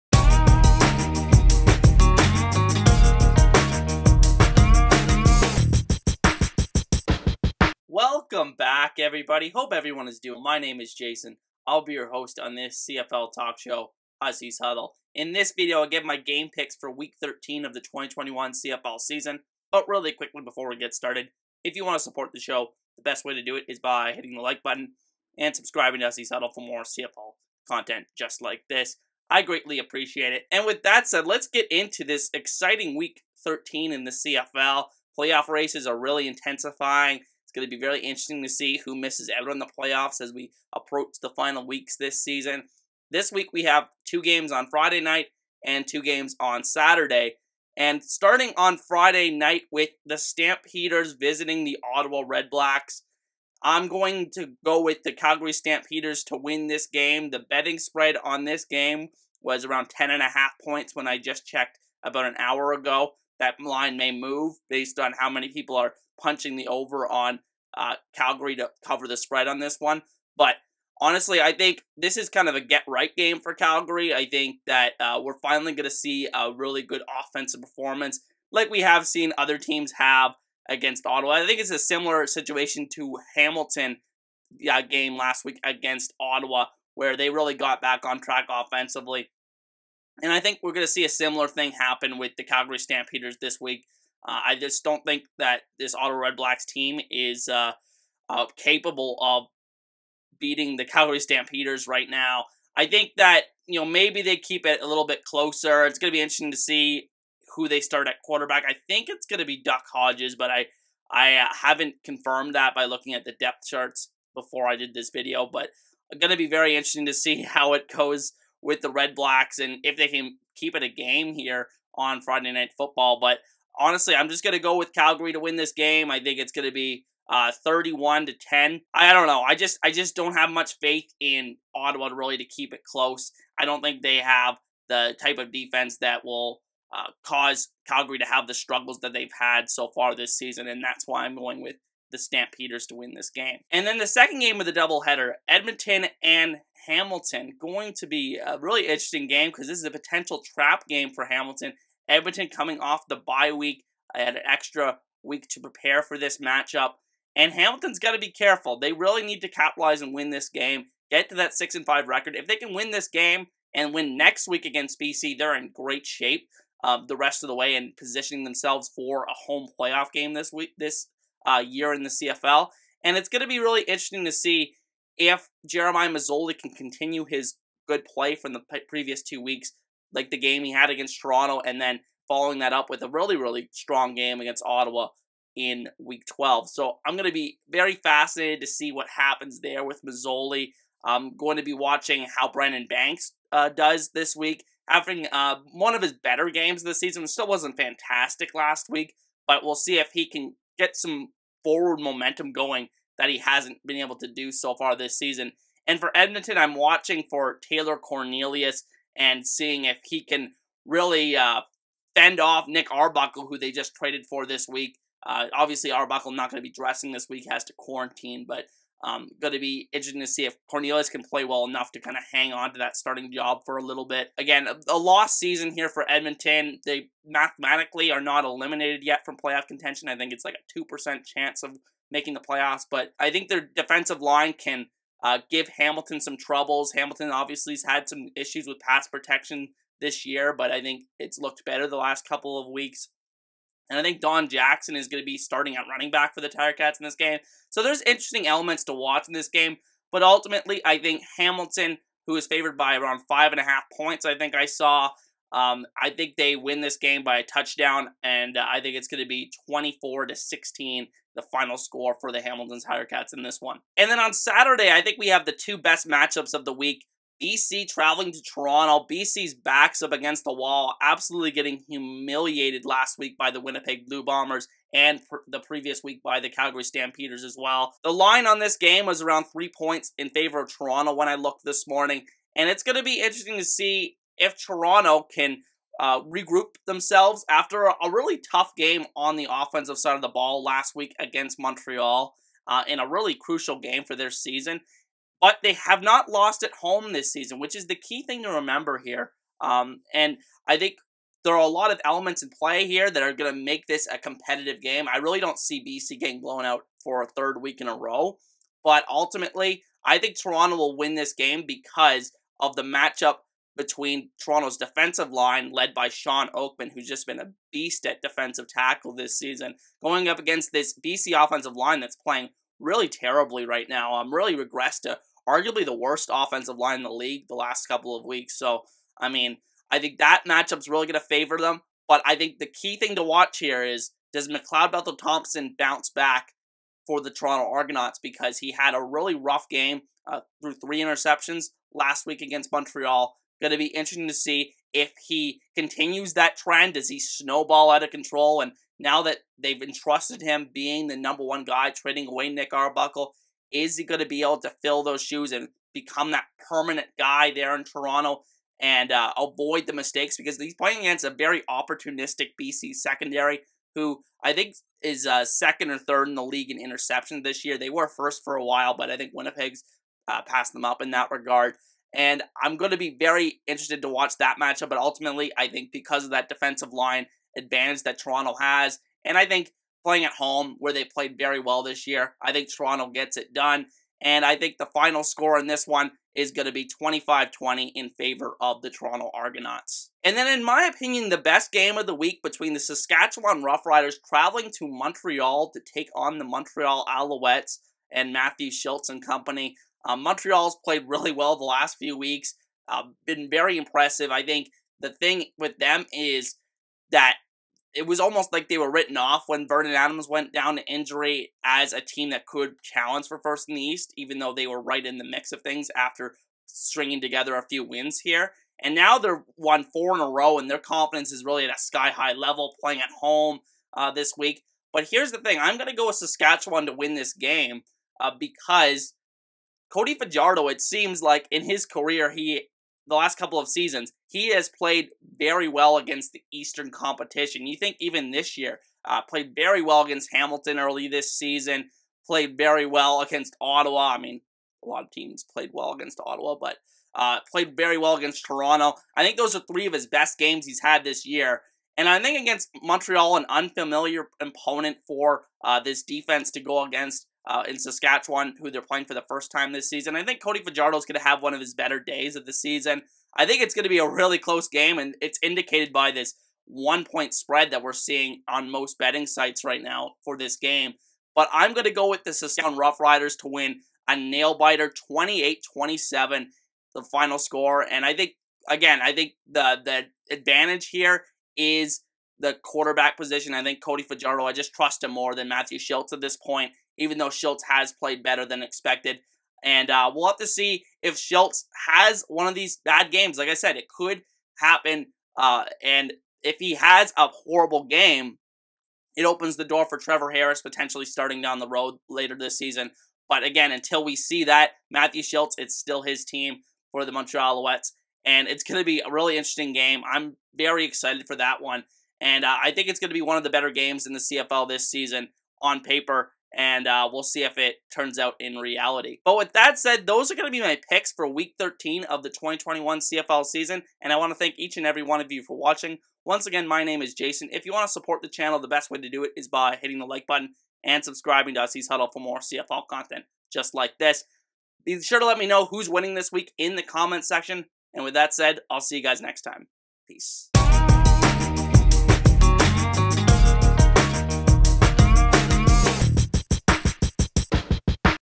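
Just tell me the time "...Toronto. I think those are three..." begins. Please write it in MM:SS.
07:28.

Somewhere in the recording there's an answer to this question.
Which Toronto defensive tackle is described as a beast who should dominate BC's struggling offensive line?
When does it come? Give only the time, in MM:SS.
05:16.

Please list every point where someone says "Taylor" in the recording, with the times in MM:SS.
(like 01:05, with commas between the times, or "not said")
03:27.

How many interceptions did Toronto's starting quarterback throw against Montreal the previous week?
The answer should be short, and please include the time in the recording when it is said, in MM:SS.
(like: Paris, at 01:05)
3, at 05:40.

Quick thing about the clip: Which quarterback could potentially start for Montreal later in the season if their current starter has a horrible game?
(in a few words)
Trevor Harris.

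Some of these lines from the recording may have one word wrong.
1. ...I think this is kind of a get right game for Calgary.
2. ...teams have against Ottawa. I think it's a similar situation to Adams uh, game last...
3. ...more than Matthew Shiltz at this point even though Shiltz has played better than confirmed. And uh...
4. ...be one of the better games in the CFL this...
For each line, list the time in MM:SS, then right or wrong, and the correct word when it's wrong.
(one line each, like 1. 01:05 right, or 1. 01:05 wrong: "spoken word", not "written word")
1. 01:11 right
2. 01:19 wrong: "Hamilton", not "Adams"
3. 08:05 wrong: "expected", not "confirmed"
4. 08:33 right.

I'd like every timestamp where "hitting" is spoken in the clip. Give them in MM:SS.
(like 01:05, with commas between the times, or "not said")
00:24, 08:49.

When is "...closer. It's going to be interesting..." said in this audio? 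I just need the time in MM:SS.
01:45.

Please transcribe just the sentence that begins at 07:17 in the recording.
You think even this year, uh, played very well against Hamilton early this season, played very well against Ottawa.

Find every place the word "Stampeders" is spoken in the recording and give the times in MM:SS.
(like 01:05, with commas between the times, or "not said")
00:50, 00:55, 01:32, 01:41, 02:22, 04:36.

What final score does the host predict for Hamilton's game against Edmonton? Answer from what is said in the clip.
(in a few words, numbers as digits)
24 to 16.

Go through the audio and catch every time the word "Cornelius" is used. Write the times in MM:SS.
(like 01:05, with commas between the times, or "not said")
03:27, 03:40.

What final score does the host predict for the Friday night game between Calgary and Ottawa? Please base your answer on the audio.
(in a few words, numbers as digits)
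31 to 10.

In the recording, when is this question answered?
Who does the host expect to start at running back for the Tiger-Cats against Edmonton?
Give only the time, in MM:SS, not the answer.
04:04.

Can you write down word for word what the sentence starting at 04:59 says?
Um, and I think there are a lot of elements in play here that are going to make this a competitive game.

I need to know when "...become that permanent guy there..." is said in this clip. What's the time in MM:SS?
05:55.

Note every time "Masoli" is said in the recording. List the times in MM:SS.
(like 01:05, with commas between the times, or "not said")
02:56, 03:10.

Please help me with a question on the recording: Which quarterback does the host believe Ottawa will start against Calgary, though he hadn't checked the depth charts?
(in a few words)
Duck Hodges.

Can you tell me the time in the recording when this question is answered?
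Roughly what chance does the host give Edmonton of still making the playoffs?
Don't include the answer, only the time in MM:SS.
03:50.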